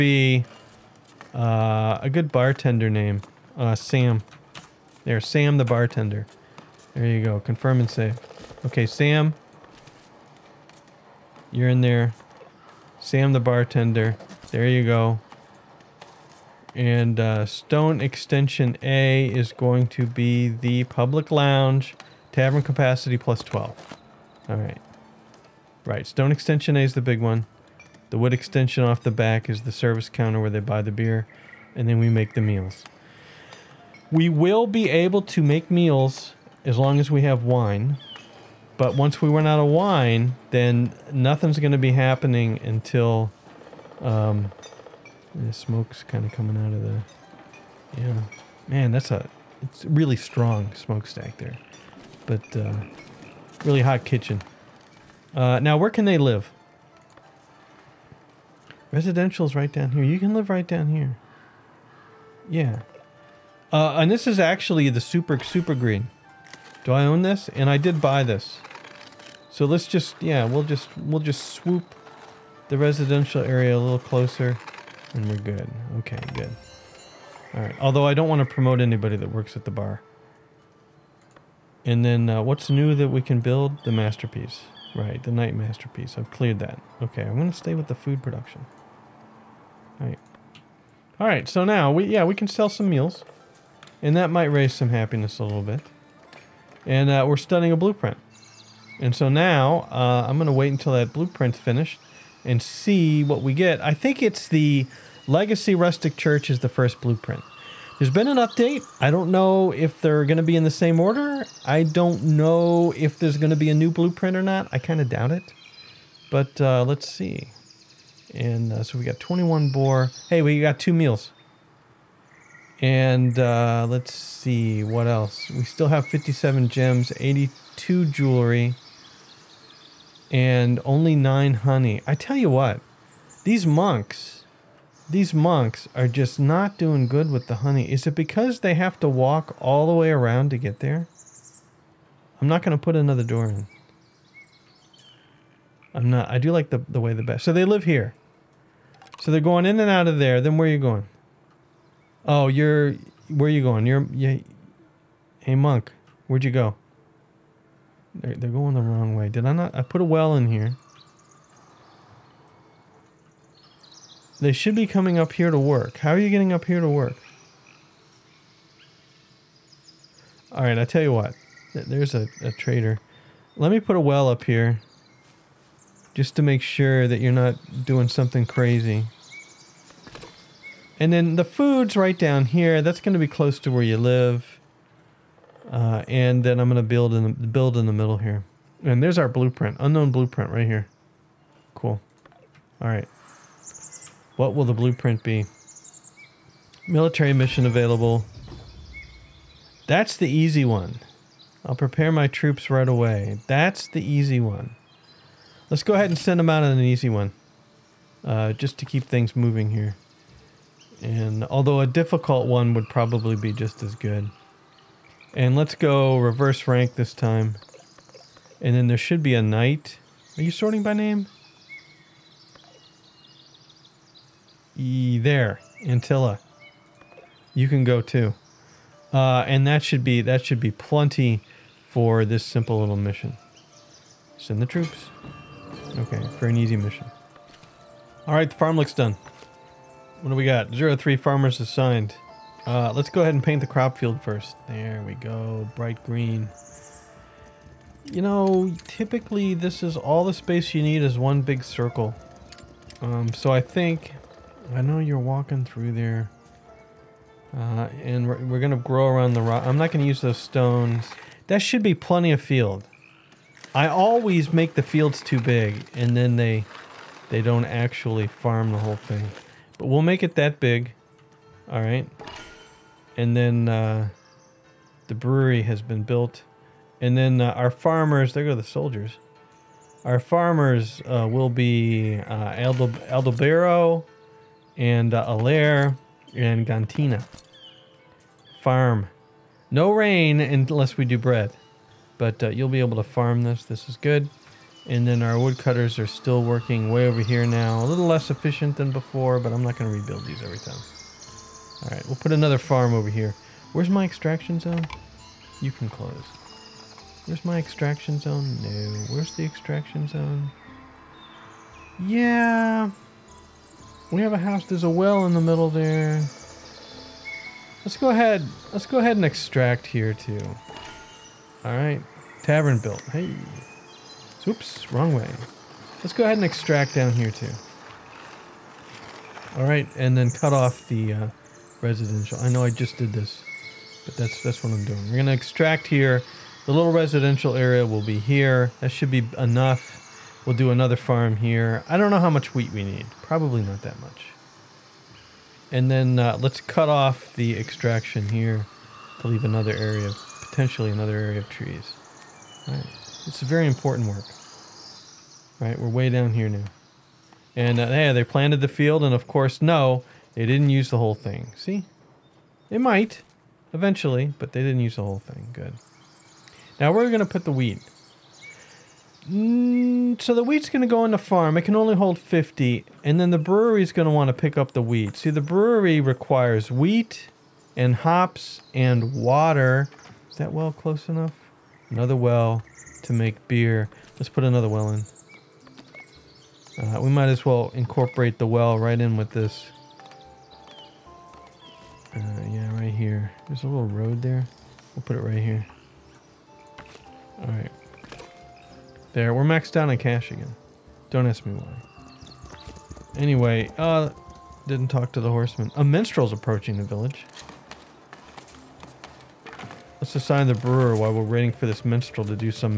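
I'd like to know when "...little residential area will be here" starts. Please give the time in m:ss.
5:36.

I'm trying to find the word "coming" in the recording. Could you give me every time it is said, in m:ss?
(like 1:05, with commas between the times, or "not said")
0:46, 2:44.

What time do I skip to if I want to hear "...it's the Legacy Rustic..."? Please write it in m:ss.
1:44.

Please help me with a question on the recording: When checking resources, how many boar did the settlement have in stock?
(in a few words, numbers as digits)
21.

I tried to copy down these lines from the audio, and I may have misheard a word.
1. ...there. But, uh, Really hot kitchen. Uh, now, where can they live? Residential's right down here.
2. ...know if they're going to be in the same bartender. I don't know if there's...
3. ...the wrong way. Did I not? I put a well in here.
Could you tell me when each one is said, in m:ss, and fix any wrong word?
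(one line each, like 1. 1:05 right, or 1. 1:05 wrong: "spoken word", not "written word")
1. 0:51 right
2. 1:49 wrong: "order", not "bartender"
3. 2:38 right.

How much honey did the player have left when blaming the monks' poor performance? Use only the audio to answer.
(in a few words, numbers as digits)
9.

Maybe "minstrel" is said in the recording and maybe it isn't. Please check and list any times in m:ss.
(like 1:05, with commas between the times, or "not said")
6:45, 6:51.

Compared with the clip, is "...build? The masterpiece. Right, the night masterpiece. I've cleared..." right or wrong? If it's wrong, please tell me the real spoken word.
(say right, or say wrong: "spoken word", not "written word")
right.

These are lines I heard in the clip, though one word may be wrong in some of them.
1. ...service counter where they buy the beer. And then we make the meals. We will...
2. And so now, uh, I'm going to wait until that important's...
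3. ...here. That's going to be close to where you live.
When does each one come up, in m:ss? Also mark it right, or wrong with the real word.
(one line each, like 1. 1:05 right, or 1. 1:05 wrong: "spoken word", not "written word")
1. 0:29 right
2. 1:38 wrong: "blueprint", not "important"
3. 3:02 right.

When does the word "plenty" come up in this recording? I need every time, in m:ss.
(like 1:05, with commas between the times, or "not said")
3:50, 4:21.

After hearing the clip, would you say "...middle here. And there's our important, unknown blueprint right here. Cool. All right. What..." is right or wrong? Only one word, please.
wrong.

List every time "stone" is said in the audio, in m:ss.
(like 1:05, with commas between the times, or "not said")
0:17, 0:26, 4:20.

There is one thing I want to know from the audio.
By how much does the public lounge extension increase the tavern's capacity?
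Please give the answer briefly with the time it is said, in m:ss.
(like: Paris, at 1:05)
plus 12, at 0:23.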